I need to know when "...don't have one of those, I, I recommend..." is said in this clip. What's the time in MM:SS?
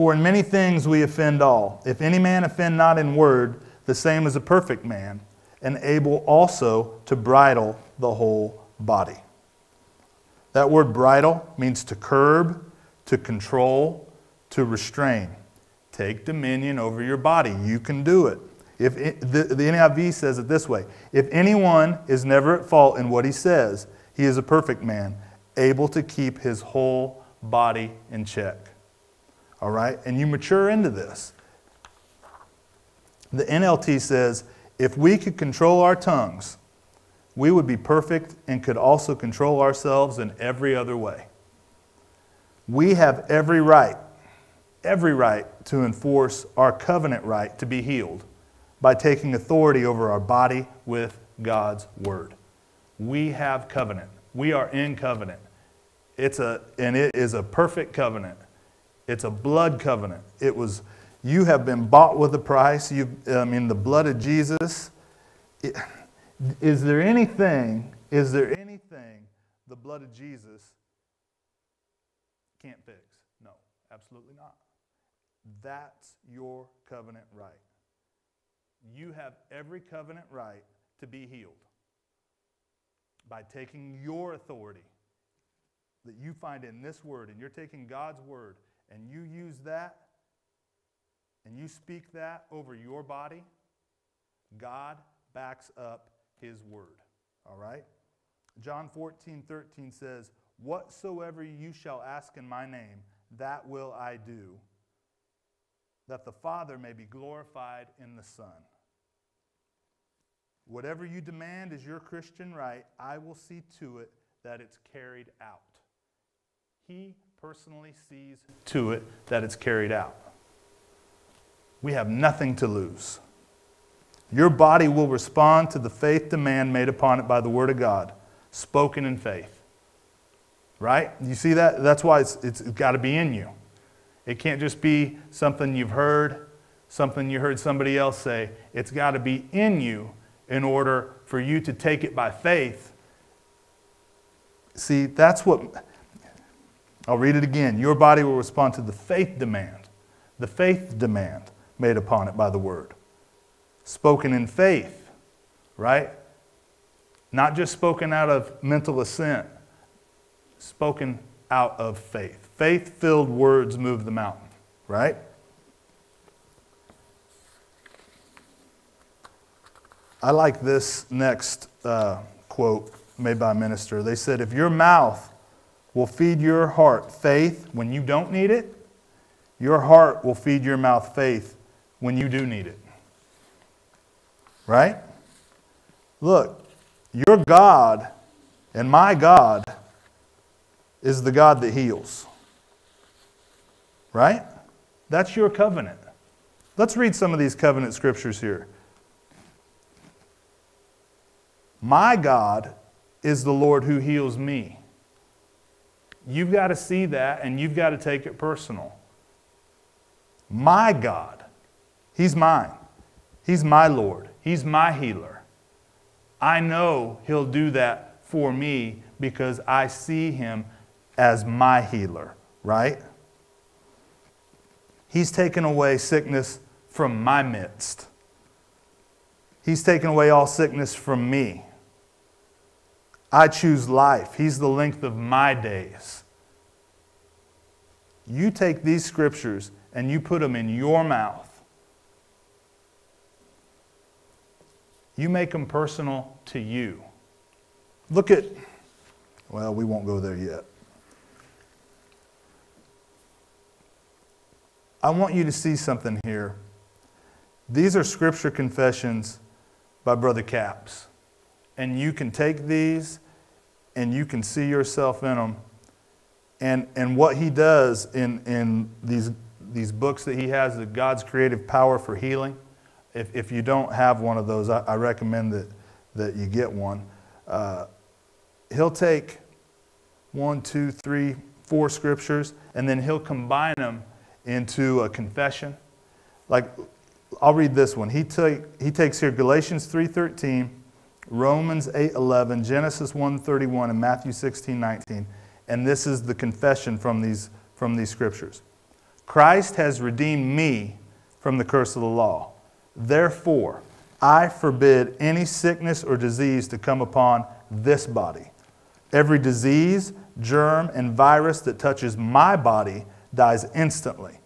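04:33.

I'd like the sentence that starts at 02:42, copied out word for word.
Faith filled words move the mountain, right?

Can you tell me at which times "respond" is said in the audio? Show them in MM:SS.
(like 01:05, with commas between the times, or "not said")
02:05, 02:28.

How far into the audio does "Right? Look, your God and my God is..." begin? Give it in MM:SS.
03:04.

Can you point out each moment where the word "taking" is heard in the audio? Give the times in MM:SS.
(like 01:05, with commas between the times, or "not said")
00:48, 01:23, 01:27.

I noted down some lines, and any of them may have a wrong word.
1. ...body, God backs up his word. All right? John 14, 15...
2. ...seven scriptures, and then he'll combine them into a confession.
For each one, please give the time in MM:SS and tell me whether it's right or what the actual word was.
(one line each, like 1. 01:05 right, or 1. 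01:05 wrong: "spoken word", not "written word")
1. 01:33 wrong: "13", not "15"
2. 04:41 wrong: "four", not "seven".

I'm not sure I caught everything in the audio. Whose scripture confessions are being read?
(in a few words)
Brother Capps.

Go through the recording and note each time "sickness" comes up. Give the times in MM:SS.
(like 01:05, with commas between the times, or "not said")
03:45, 03:50, 05:05.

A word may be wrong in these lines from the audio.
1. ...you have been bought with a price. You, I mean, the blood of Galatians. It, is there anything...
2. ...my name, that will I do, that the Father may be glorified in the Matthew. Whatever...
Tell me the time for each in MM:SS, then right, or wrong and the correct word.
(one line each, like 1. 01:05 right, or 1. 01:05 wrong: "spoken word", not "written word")
1. 01:01 wrong: "Jesus", not "Galatians"
2. 01:42 wrong: "Son", not "Matthew".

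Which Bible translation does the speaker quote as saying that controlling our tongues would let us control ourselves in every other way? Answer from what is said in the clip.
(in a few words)
NLT.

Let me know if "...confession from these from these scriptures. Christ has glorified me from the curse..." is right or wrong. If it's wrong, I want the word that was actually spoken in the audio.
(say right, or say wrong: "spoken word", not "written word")
wrong: "redeemed", not "glorified".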